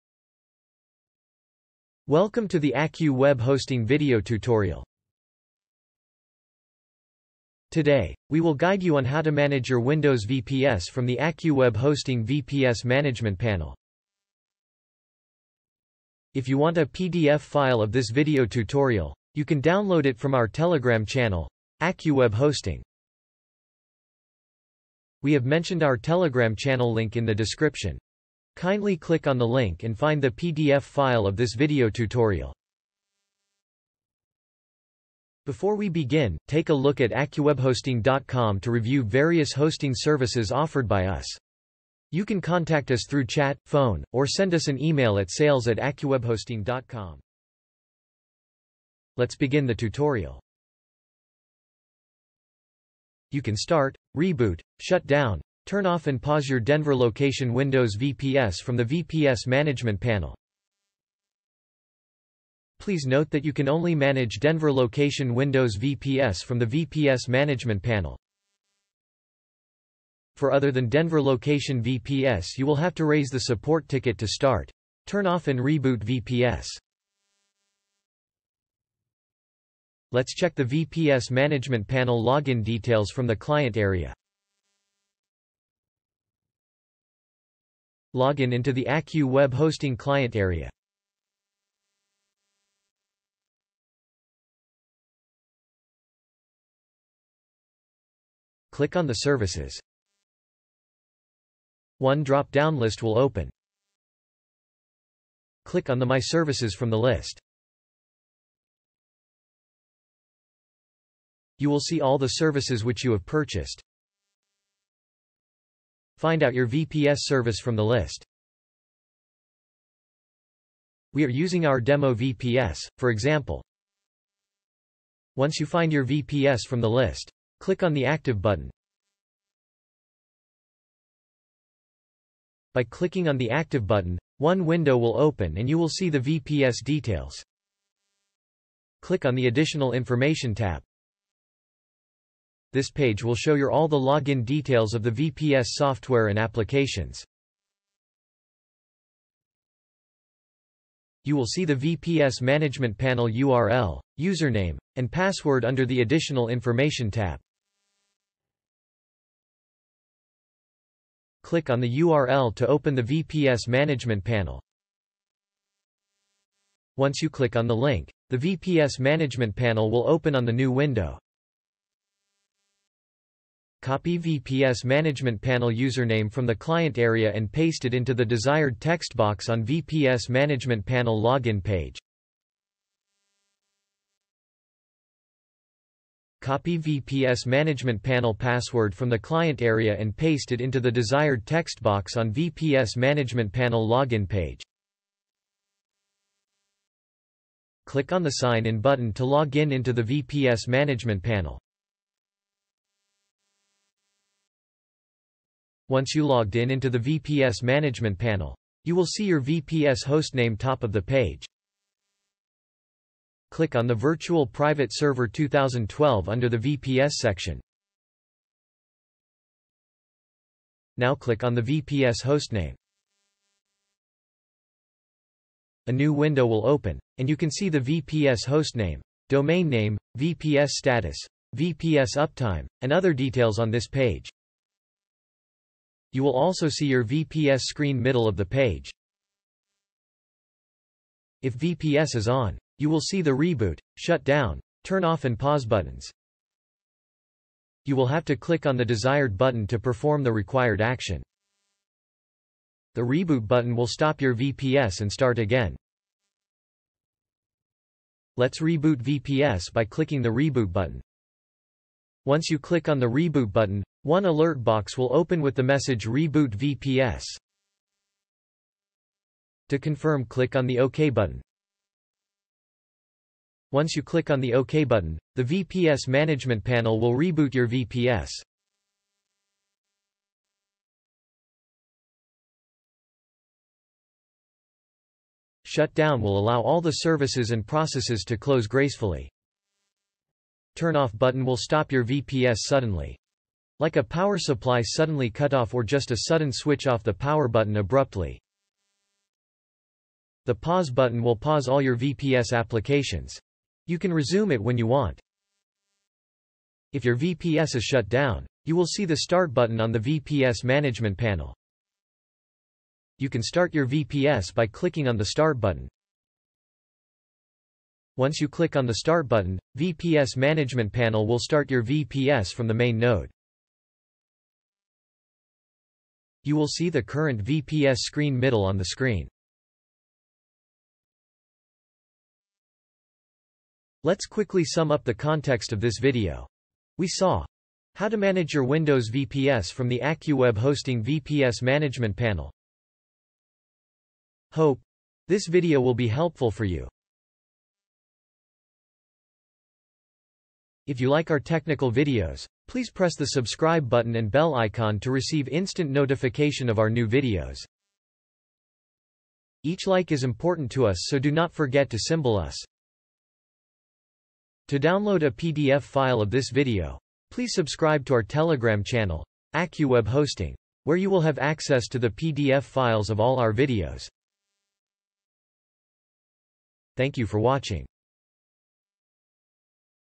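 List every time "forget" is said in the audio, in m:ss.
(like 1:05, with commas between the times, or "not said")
6:01.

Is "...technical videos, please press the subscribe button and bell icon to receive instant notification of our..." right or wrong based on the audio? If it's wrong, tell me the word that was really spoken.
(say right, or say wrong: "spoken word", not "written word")
right.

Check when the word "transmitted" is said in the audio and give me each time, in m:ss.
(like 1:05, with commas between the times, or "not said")
not said.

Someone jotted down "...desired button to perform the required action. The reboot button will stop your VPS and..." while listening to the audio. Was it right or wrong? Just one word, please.
right.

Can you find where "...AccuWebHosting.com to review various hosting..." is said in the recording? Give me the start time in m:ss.
0:37.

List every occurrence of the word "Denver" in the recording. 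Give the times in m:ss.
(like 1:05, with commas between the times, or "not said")
0:56, 1:04, 1:10.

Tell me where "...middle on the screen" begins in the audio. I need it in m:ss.
5:28.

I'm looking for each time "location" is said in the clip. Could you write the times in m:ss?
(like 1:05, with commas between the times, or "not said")
0:56, 1:04, 1:11.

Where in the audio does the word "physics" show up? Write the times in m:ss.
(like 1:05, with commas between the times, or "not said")
not said.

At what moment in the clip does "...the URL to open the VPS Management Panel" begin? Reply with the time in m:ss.
2:41.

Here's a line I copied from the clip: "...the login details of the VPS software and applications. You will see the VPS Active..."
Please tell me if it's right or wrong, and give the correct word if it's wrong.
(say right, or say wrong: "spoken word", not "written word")
wrong: "Management", not "Active".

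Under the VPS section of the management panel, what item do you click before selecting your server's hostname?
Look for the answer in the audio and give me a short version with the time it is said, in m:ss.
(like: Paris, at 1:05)
Virtual Private Server 2012, at 3:33.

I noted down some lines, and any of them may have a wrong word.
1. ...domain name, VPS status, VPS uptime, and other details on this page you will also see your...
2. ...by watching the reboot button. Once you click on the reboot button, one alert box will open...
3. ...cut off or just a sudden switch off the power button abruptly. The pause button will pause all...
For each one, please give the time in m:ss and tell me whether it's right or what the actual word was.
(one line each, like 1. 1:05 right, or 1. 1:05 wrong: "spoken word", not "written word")
1. 3:49 right
2. 4:19 wrong: "clicking", not "watching"
3. 4:55 right.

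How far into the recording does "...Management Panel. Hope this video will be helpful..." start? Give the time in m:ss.
5:41.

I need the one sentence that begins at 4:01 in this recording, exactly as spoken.
If VPS is on, you will see the reboot, shut down, turn off and pause buttons.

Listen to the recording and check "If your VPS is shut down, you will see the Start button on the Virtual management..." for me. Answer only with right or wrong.
wrong.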